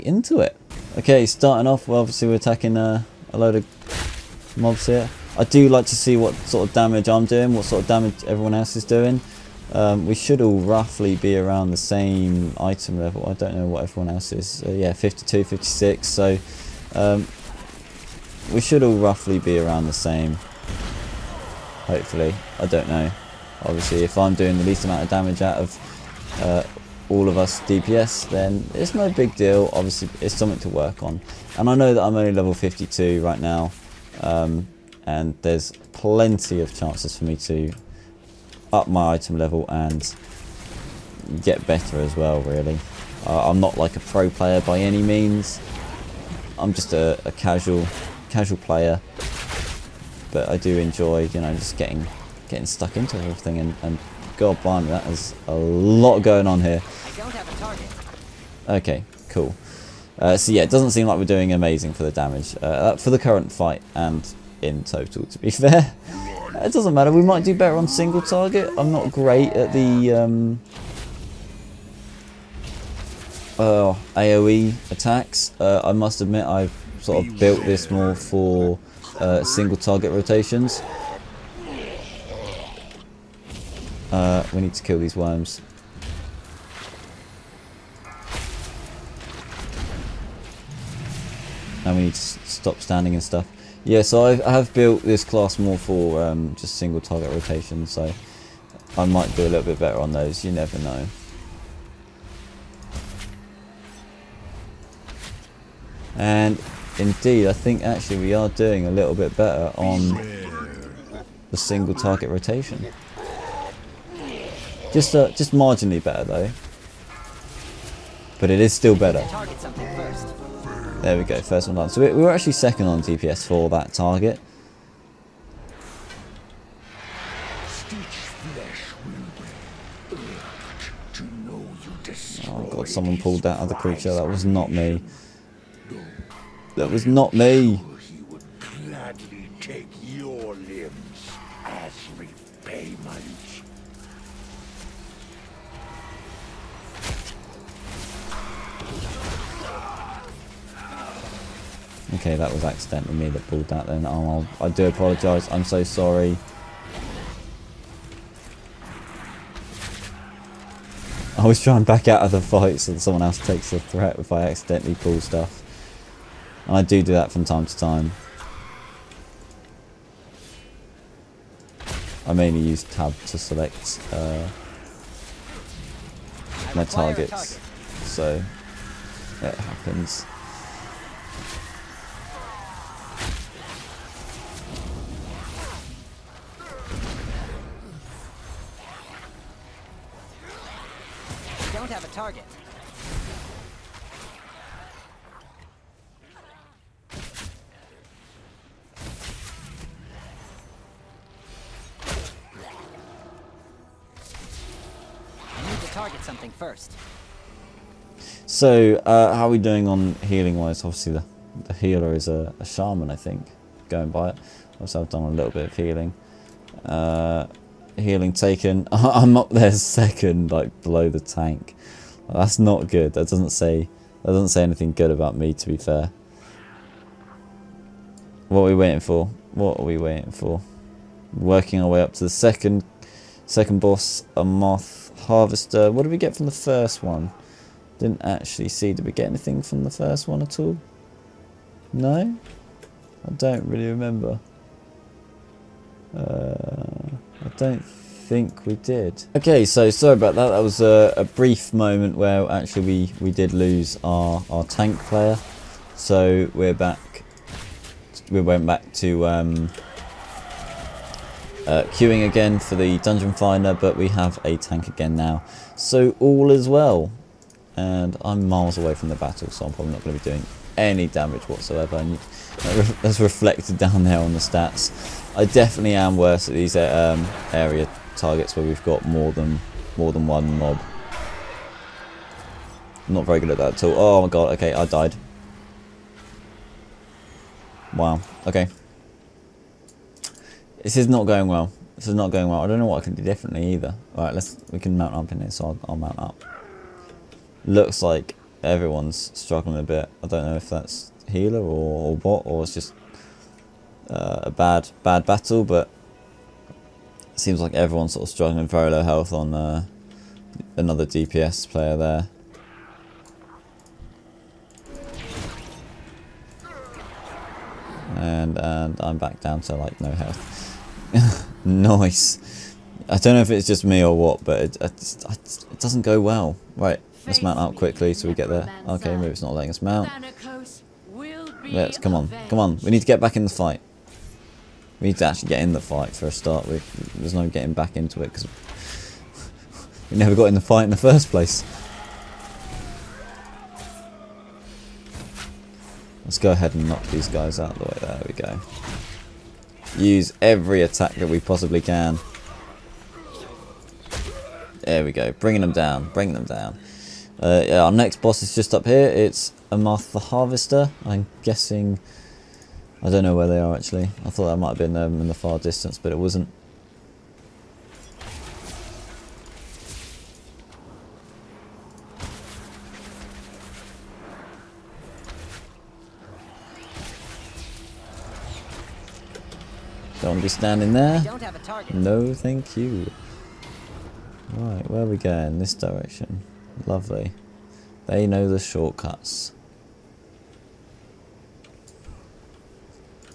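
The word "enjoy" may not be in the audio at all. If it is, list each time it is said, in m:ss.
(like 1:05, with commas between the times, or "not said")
0:50.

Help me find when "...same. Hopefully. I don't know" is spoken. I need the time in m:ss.
0:19.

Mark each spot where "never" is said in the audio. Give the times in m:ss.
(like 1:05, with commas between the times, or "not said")
1:40, 5:40.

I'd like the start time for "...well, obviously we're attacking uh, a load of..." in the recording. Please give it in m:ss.
0:01.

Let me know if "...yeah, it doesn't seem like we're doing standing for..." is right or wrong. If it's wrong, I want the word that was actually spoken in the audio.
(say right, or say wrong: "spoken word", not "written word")
wrong: "amazing", not "standing".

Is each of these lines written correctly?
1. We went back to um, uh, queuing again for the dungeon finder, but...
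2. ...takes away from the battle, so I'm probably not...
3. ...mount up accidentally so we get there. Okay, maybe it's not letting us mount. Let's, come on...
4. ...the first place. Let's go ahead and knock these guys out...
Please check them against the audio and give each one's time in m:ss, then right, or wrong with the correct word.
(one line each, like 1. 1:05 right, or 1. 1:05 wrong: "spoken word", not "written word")
1. 4:18 right
2. 4:28 wrong: "miles", not "takes"
3. 5:27 wrong: "quickly", not "accidentally"
4. 5:40 right.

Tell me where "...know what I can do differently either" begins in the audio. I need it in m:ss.
4:52.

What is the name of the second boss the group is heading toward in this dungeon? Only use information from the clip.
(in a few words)
Amarth the Harvester.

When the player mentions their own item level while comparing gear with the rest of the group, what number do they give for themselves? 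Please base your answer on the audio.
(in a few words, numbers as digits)
52.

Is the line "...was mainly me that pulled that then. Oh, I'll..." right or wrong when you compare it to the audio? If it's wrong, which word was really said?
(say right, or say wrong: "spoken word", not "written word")
wrong: "accidentally", not "mainly".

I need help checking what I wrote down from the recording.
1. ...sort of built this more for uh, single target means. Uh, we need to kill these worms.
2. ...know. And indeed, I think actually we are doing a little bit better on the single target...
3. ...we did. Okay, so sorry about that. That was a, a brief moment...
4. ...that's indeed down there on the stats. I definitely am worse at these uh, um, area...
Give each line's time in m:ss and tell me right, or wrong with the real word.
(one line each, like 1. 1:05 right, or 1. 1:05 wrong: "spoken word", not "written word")
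1. 1:17 wrong: "rotations", not "means"
2. 1:40 right
3. 4:08 right
4. 4:33 wrong: "reflected", not "indeed".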